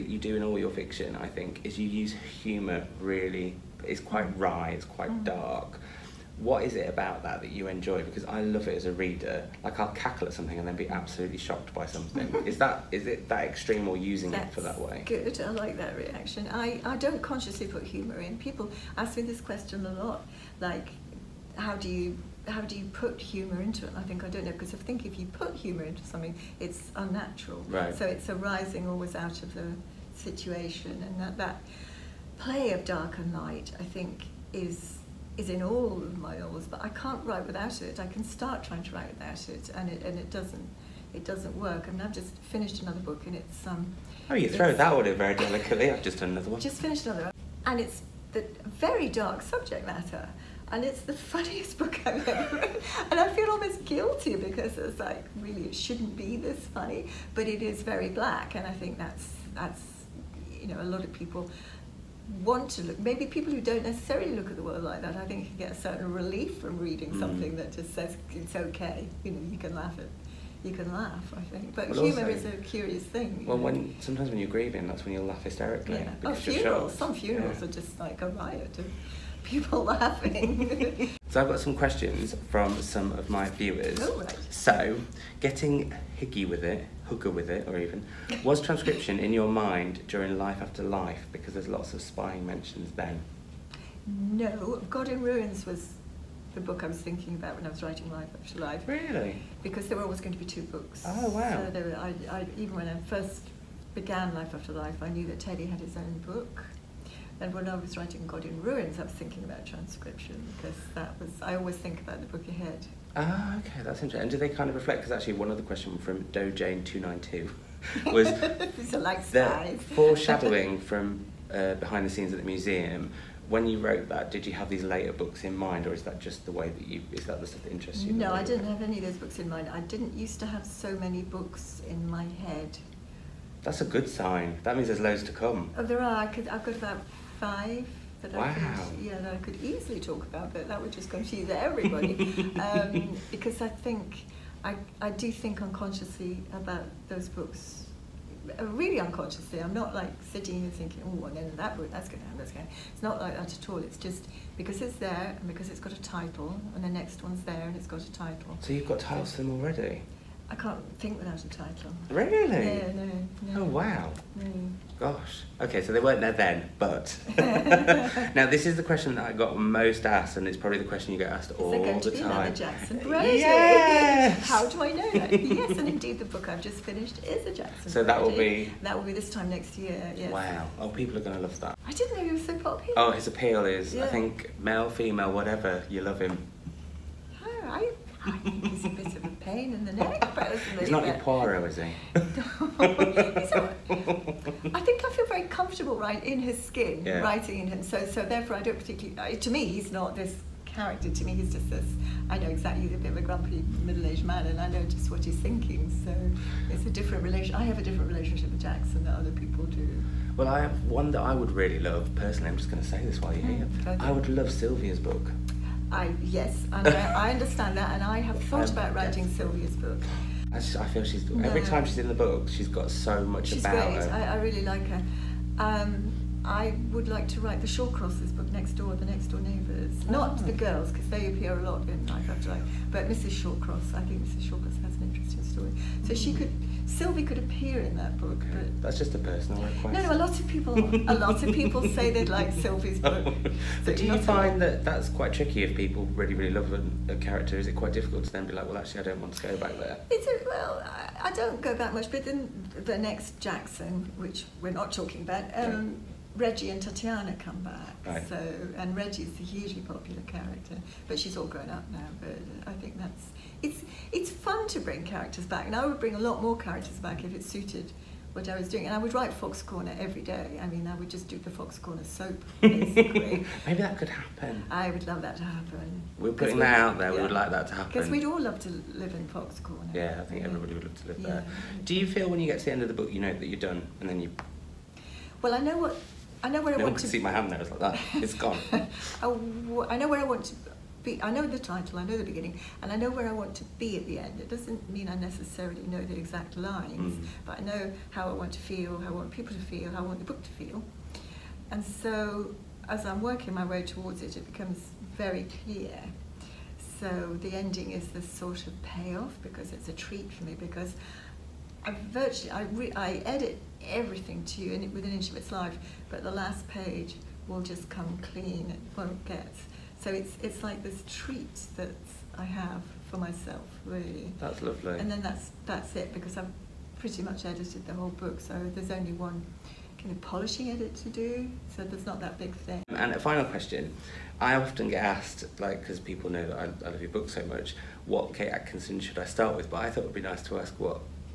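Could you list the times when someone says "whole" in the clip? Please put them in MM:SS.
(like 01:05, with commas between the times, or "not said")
05:27.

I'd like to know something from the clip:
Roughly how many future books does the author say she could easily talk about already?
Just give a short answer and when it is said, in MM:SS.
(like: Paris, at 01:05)
5, at 02:17.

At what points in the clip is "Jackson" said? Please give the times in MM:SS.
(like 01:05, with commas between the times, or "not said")
02:52, 02:57, 03:28, 04:13.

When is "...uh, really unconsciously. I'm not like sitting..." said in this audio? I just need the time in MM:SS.
02:28.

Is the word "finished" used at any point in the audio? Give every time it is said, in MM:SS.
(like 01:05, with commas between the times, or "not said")
00:42, 00:46, 02:56.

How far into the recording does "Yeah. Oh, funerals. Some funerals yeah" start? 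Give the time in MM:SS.
01:15.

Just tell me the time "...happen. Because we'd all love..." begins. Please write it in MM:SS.
04:37.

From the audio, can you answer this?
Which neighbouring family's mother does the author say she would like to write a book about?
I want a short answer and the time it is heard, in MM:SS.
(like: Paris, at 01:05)
The Shawcrosses, at 03:47.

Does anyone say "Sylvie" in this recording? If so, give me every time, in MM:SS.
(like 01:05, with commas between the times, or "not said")
03:34, 03:39, 03:56, 04:02.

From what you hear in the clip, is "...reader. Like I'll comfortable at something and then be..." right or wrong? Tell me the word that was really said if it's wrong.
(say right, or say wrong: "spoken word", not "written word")
wrong: "cackle", not "comfortable".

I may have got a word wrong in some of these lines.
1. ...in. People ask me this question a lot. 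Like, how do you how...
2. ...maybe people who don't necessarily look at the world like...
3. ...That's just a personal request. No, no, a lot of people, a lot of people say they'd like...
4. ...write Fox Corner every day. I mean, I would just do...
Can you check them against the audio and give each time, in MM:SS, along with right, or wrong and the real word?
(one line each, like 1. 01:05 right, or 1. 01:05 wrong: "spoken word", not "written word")
1. 00:18 right
2. 01:02 right
3. 03:58 right
4. 04:29 right.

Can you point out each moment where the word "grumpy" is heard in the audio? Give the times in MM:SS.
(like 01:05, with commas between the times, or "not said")
03:23.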